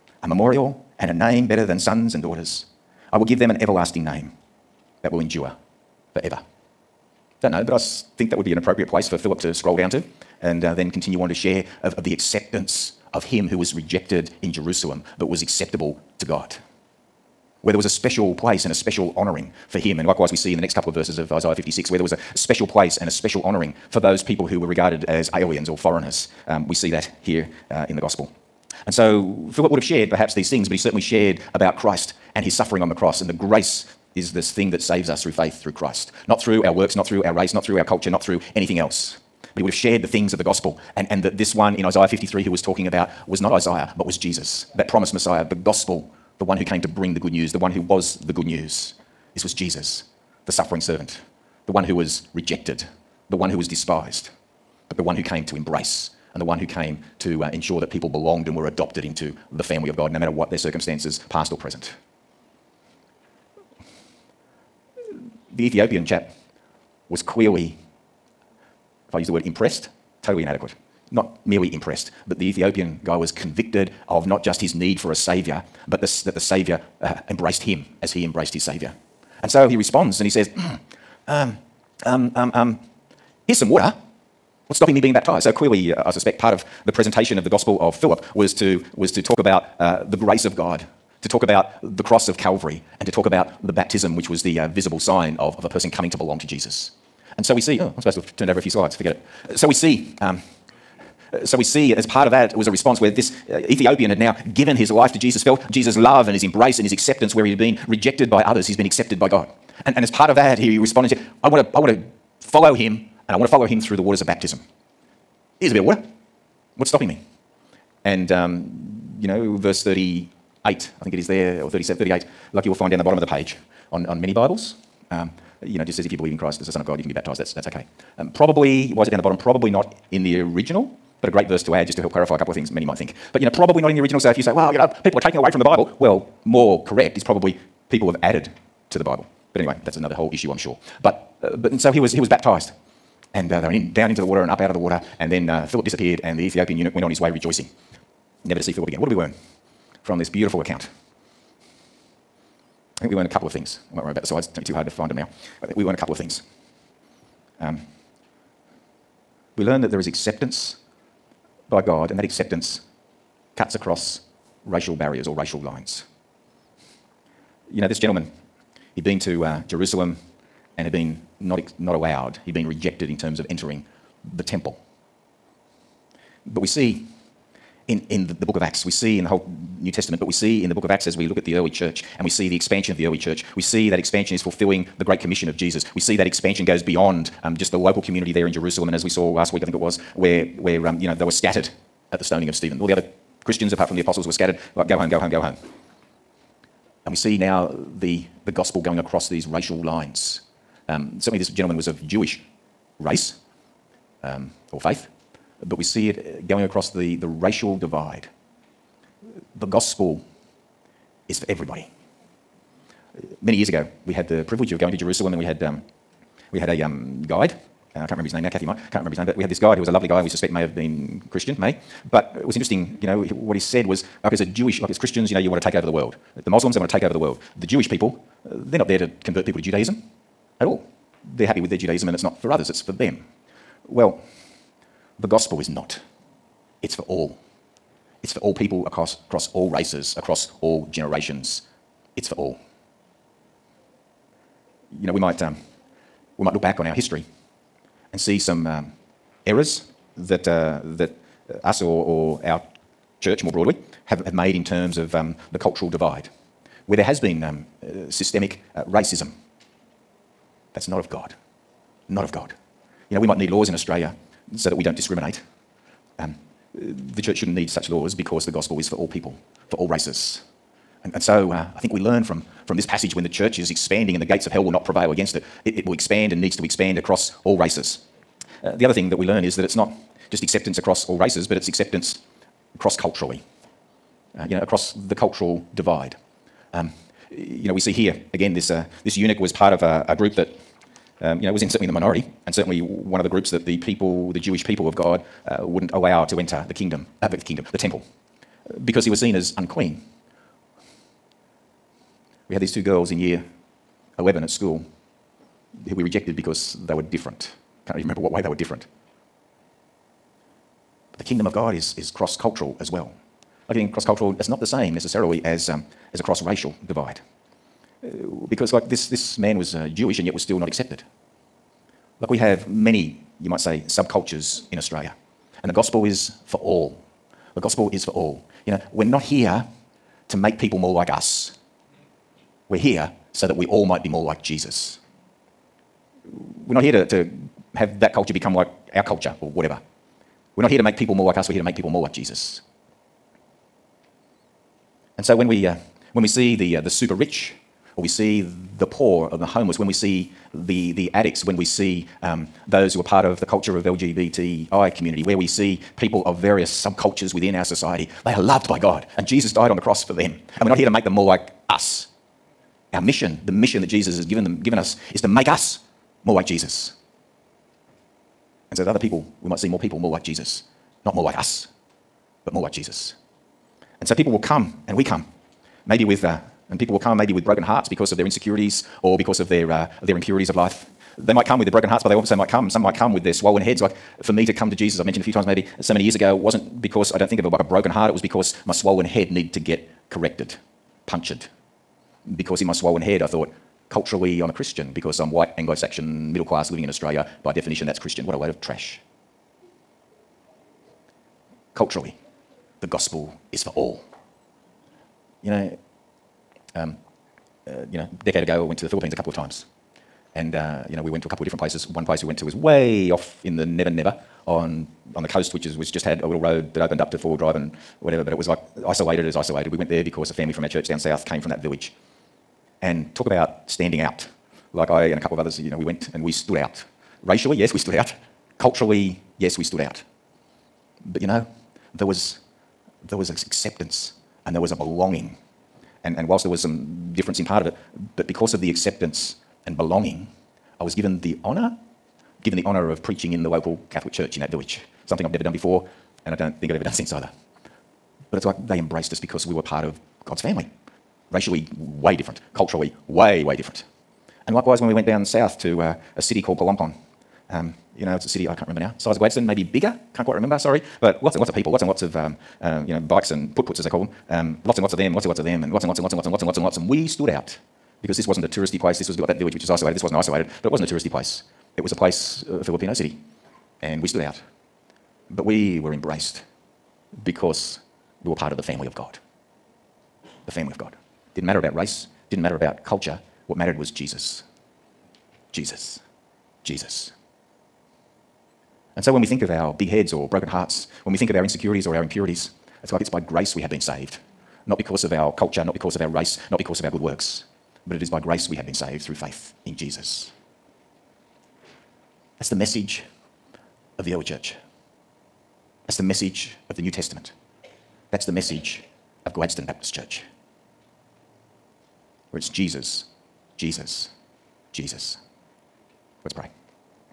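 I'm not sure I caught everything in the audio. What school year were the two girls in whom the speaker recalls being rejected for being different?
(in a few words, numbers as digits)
Year 11.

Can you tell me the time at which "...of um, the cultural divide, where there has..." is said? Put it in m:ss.
4:14.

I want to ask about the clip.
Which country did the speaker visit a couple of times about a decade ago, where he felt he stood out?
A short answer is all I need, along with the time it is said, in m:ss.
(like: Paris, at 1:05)
The Philippines, at 6:48.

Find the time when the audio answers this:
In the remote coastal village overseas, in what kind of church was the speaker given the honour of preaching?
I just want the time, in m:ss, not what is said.
7:23.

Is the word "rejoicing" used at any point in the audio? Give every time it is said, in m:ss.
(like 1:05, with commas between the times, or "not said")
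2:27.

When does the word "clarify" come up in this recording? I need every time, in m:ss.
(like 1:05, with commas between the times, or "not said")
2:12.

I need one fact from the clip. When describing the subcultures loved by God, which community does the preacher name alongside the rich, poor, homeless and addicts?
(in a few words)
LGBTI.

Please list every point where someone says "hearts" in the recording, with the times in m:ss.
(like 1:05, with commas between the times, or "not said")
6:17, 6:21, 6:27, 8:10.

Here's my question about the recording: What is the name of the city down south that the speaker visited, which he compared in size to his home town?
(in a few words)
Palompon.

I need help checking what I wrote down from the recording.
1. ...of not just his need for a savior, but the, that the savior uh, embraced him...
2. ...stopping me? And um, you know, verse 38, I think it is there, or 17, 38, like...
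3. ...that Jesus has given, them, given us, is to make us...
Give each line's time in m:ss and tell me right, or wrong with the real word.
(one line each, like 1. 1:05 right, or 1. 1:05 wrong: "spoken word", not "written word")
1. 1:14 right
2. 1:56 wrong: "37", not "17"
3. 6:03 right.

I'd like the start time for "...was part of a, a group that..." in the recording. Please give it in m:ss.
4:49.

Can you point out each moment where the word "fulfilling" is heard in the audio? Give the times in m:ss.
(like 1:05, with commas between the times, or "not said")
3:04.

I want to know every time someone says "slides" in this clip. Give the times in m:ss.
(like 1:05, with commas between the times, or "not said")
1:38, 2:34.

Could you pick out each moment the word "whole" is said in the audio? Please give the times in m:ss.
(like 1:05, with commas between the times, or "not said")
2:20, 2:59.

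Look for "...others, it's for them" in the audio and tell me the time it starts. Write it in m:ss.
3:52.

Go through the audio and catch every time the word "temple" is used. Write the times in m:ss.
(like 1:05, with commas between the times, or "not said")
2:54, 4:57.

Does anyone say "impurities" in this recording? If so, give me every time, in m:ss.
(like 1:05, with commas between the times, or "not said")
6:20, 8:12.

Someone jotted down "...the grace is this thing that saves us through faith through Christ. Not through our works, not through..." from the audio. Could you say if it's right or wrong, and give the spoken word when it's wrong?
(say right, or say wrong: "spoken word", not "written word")
right.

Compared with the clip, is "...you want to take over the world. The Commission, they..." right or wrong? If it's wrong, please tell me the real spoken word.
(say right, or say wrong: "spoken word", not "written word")
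wrong: "Muslims", not "Commission".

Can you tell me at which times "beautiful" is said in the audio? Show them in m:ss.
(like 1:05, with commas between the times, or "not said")
2:30.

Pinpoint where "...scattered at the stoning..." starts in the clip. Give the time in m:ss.
3:11.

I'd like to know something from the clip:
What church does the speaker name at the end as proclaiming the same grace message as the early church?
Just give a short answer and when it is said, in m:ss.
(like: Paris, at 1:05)
Gladstone Baptist Church, at 8:29.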